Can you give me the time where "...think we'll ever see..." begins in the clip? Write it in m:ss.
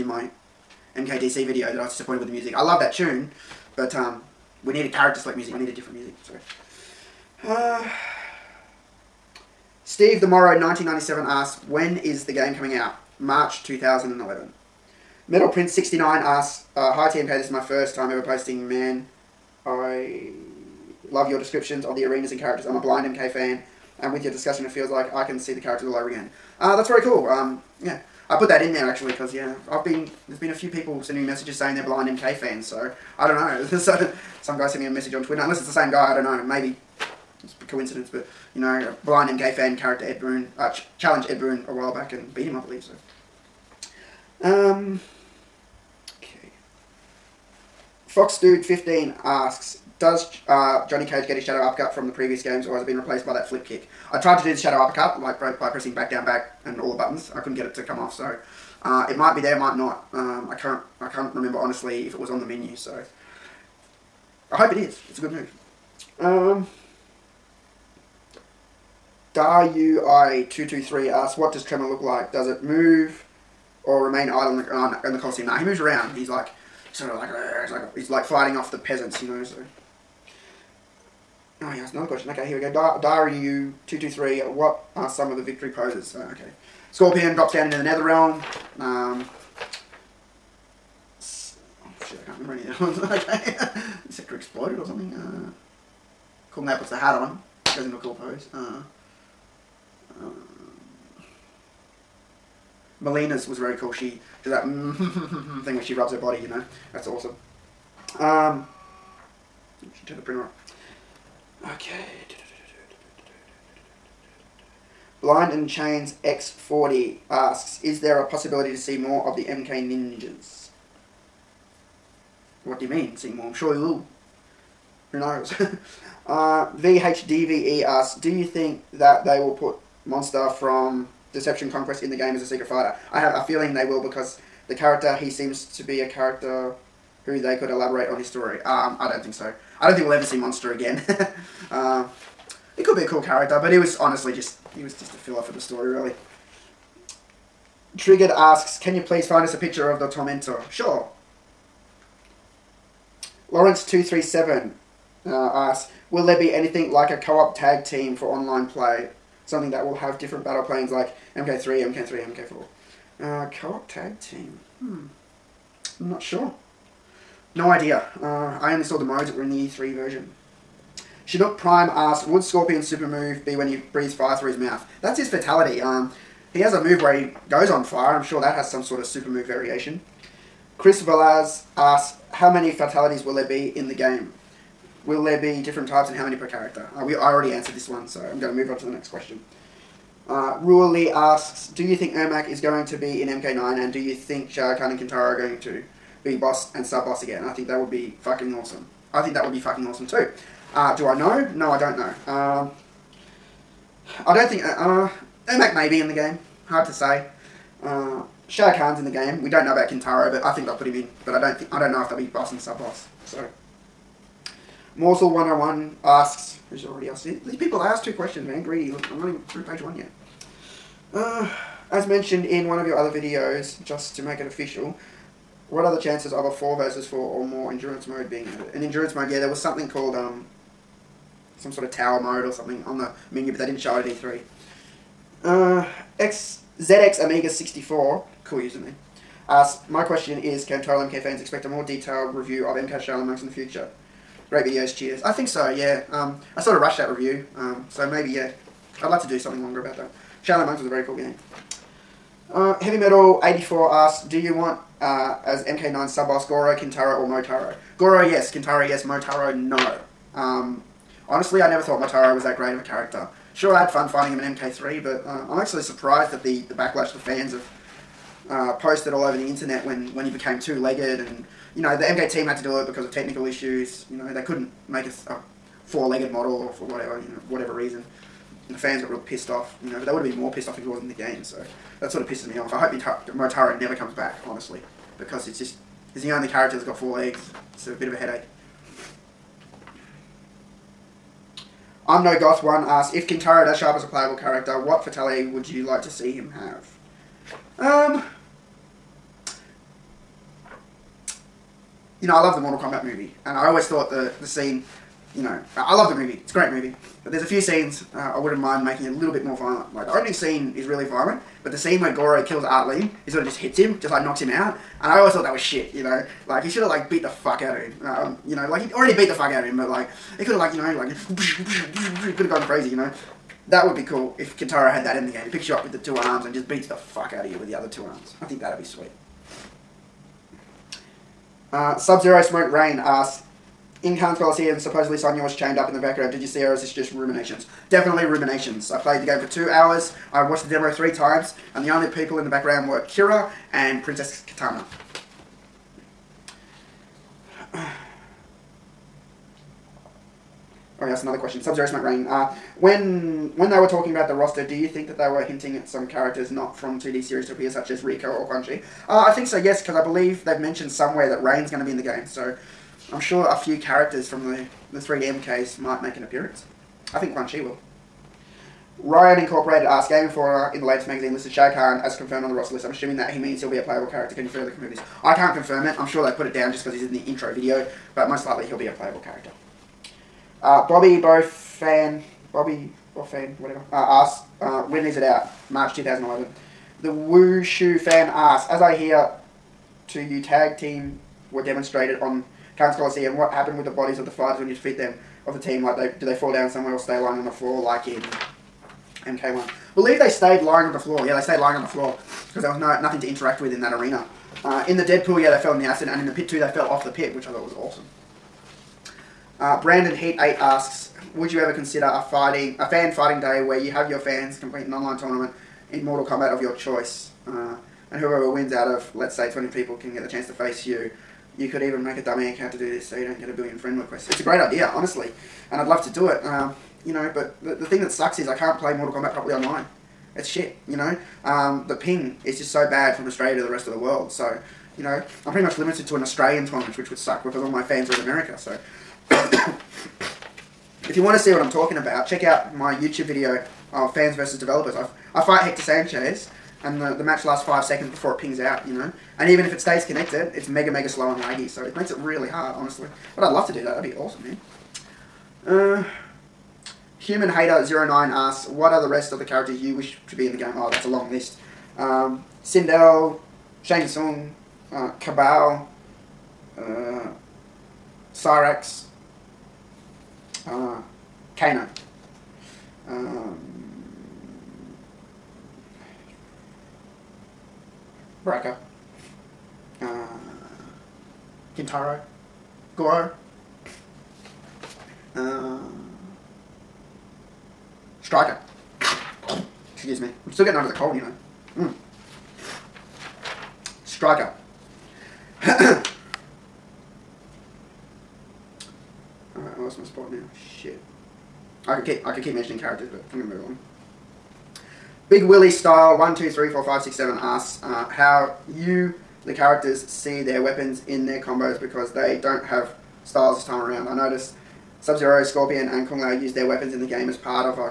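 2:19.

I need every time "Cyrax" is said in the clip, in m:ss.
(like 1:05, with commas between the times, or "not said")
7:48.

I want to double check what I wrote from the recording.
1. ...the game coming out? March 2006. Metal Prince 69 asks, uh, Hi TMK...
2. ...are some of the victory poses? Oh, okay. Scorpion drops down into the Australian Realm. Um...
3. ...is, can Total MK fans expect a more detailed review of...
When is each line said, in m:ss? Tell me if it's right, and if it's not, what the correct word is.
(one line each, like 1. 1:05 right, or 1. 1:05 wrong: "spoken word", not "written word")
1. 0:12 wrong: "2011", not "2006"
2. 1:24 wrong: "Nether", not "Australian"
3. 4:00 right.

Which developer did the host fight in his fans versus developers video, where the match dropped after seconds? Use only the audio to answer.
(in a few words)
Hector Sanchez.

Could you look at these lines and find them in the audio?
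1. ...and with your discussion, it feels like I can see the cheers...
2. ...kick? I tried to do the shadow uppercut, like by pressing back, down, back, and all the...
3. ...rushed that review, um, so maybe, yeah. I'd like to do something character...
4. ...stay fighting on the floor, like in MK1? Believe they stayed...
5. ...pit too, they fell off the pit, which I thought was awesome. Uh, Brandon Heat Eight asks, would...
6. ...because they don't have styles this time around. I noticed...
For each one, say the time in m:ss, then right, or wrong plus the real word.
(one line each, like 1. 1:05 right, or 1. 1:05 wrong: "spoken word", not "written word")
1. 0:23 wrong: "characters", not "cheers"
2. 0:53 right
3. 4:06 wrong: "longer", not "character"
4. 6:36 wrong: "lying", not "fighting"
5. 6:46 right
6. 8:31 right.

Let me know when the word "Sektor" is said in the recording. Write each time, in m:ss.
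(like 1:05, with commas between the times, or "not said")
1:34.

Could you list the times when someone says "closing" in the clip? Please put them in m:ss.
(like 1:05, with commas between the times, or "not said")
not said.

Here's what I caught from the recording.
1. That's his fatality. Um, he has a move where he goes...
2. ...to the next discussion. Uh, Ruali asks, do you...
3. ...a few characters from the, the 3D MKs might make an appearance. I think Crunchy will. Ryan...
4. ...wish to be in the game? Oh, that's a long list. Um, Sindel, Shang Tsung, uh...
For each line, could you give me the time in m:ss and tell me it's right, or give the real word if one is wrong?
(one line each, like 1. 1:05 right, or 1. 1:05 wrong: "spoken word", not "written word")
1. 2:55 right
2. 3:08 wrong: "question", not "discussion"
3. 6:03 right
4. 7:39 right.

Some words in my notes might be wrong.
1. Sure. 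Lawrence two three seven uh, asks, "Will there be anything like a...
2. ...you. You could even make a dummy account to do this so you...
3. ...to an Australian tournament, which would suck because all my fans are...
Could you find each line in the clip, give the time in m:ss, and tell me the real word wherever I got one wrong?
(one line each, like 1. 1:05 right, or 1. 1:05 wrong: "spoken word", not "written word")
1. 2:30 right
2. 7:00 right
3. 7:16 right.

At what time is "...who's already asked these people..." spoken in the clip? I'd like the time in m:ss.
3:36.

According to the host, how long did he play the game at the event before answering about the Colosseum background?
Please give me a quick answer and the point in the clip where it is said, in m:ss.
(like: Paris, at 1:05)
2 hours, at 5:39.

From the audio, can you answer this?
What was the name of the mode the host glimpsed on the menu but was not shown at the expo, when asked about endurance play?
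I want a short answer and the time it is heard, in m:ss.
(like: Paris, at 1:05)
tower mode, at 3:51.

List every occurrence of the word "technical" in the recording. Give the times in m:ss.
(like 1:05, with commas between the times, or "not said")
4:33.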